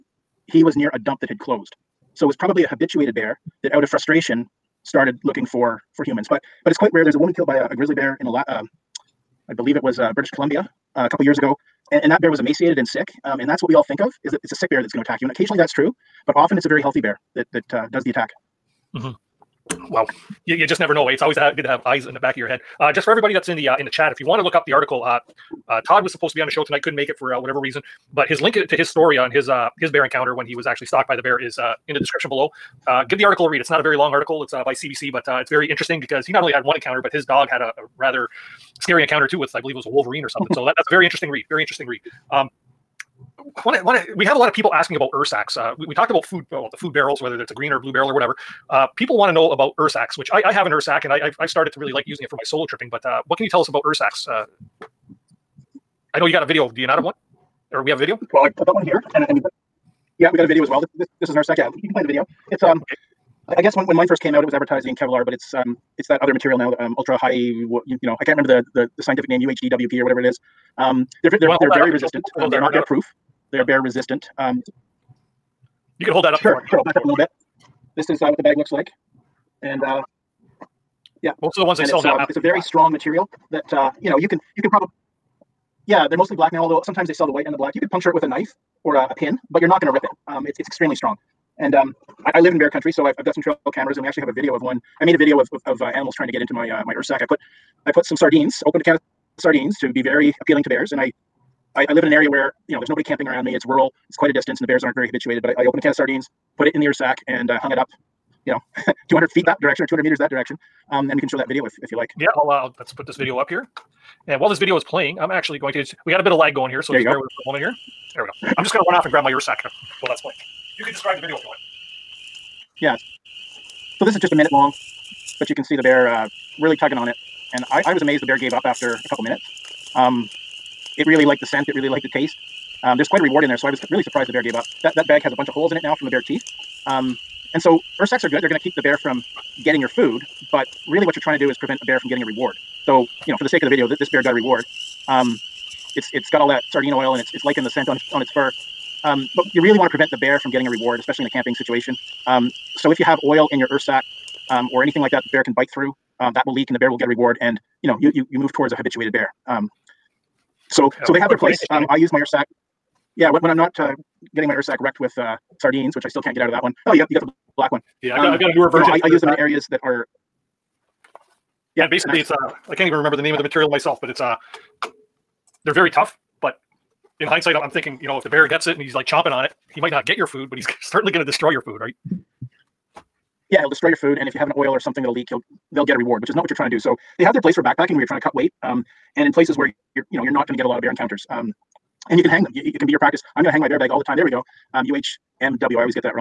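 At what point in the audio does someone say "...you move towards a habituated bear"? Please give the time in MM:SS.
02:38.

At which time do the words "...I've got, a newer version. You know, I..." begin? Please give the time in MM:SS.
02:48.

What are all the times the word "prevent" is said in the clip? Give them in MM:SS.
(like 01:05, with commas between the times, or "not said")
02:21, 02:29.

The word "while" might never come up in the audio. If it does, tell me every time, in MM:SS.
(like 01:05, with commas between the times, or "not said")
01:54, 02:00.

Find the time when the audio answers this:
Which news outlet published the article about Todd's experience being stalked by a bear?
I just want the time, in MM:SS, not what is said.
00:34.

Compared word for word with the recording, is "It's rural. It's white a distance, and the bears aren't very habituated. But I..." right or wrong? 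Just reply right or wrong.
wrong.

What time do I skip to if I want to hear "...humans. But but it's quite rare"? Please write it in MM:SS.
00:06.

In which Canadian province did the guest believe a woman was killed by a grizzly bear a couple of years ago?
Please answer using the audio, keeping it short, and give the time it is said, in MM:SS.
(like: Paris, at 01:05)
British Columbia, at 00:10.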